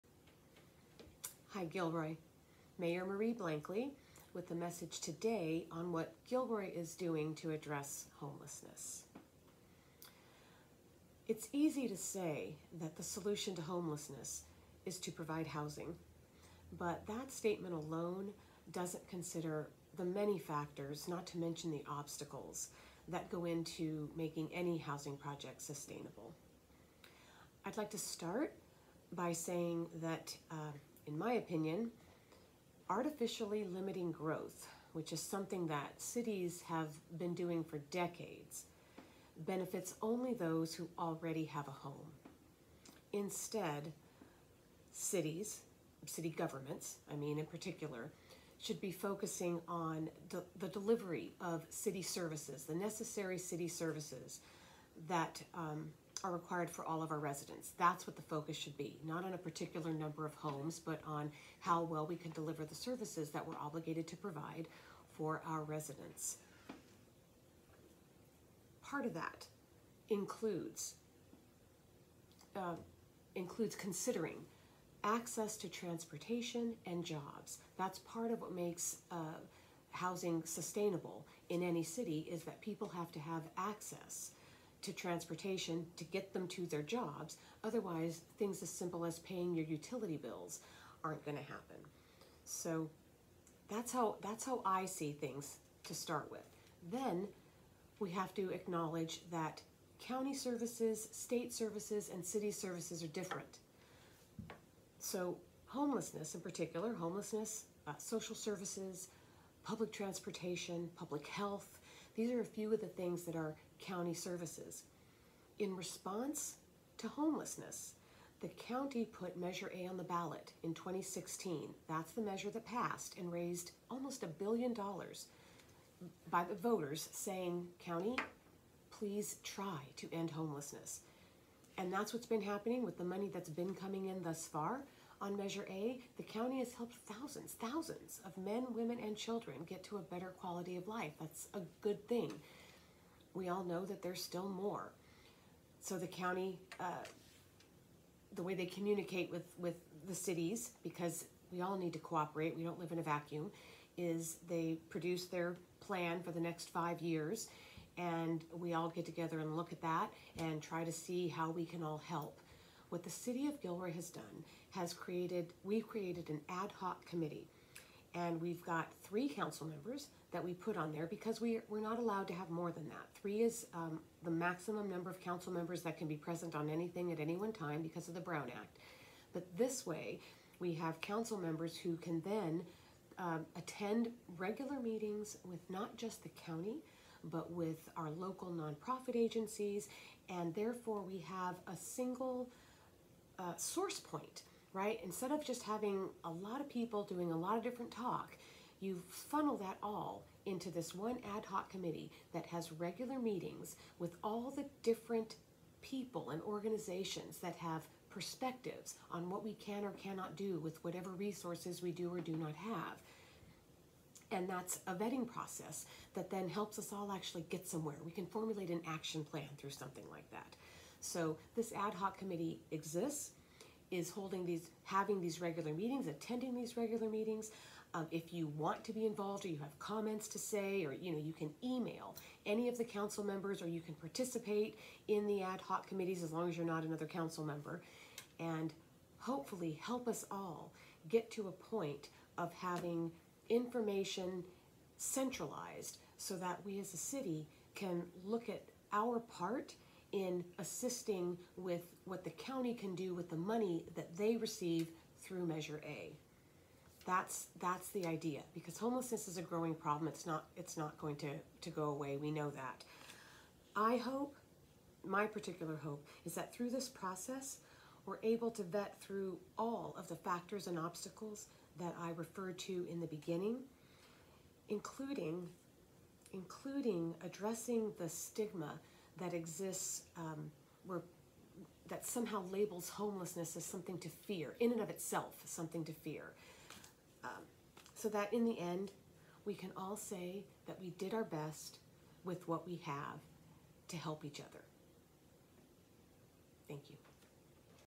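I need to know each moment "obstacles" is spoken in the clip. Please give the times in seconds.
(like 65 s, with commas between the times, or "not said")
21 s, 270 s.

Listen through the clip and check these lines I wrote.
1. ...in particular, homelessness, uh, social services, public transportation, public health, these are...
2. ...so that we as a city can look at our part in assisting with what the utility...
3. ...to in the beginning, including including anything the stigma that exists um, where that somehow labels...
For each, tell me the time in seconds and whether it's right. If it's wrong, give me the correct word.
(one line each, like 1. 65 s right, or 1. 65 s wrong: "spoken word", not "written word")
1. 106 s right
2. 246 s wrong: "county", not "utility"
3. 272 s wrong: "addressing", not "anything".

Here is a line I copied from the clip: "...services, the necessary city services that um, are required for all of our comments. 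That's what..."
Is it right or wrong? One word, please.
wrong.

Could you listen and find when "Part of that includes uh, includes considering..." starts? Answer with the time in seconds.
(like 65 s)
68 s.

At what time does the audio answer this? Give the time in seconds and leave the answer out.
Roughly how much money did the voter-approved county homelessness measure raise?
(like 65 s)
123 s.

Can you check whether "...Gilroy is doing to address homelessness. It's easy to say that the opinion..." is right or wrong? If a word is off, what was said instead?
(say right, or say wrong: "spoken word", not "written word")
wrong: "solution", not "opinion".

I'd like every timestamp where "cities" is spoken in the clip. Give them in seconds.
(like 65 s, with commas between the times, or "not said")
35 s, 44 s, 150 s.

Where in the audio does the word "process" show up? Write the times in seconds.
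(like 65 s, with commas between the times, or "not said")
215 s, 266 s.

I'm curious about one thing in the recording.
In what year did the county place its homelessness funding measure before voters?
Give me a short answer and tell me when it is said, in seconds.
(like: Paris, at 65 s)
2016, at 120 s.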